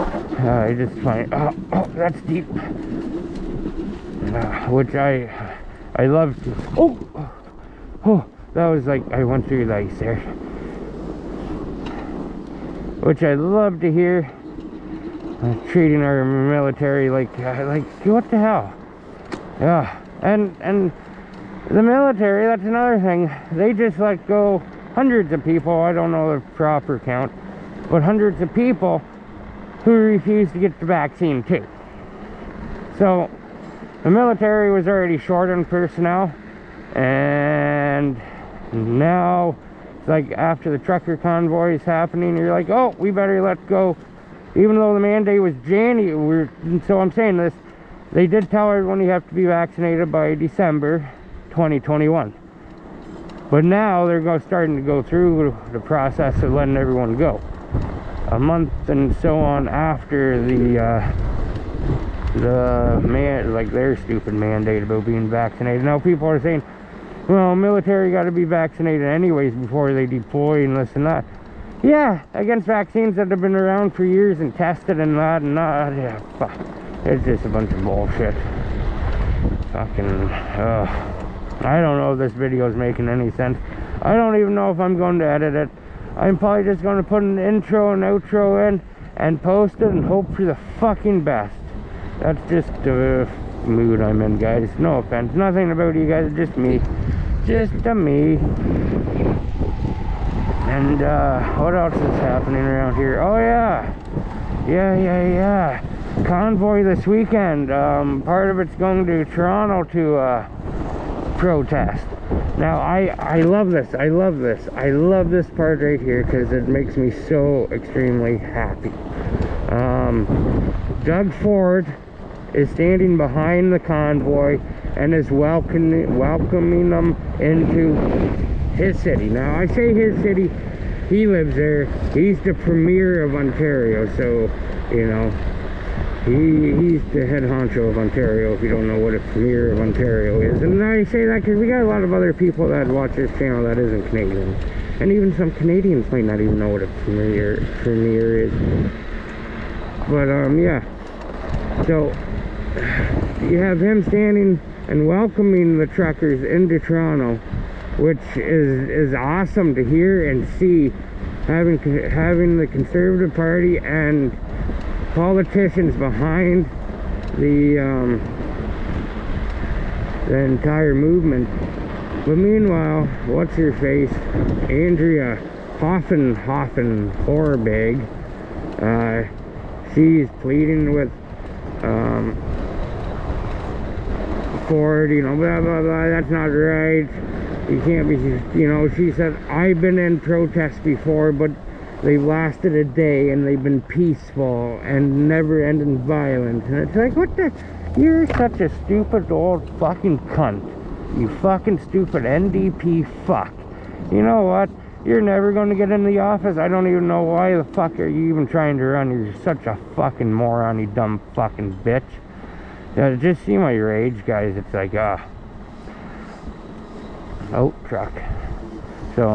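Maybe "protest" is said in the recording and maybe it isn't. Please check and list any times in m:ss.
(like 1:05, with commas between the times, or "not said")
1:51, 3:10.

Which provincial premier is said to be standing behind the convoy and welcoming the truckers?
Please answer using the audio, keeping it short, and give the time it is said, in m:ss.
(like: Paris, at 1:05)
Doug Ford, at 2:01.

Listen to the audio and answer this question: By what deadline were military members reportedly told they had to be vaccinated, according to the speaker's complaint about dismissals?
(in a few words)
December 2021.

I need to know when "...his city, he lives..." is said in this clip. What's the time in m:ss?
2:09.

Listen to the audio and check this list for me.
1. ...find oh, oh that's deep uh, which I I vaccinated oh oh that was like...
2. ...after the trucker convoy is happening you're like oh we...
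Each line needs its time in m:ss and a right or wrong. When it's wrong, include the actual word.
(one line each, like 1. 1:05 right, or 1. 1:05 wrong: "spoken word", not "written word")
1. 0:01 wrong: "loved", not "vaccinated"
2. 0:40 right.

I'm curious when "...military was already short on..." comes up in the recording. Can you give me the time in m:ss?
0:34.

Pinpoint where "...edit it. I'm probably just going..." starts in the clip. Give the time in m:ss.
1:25.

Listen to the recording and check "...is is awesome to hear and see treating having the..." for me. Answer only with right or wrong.
wrong.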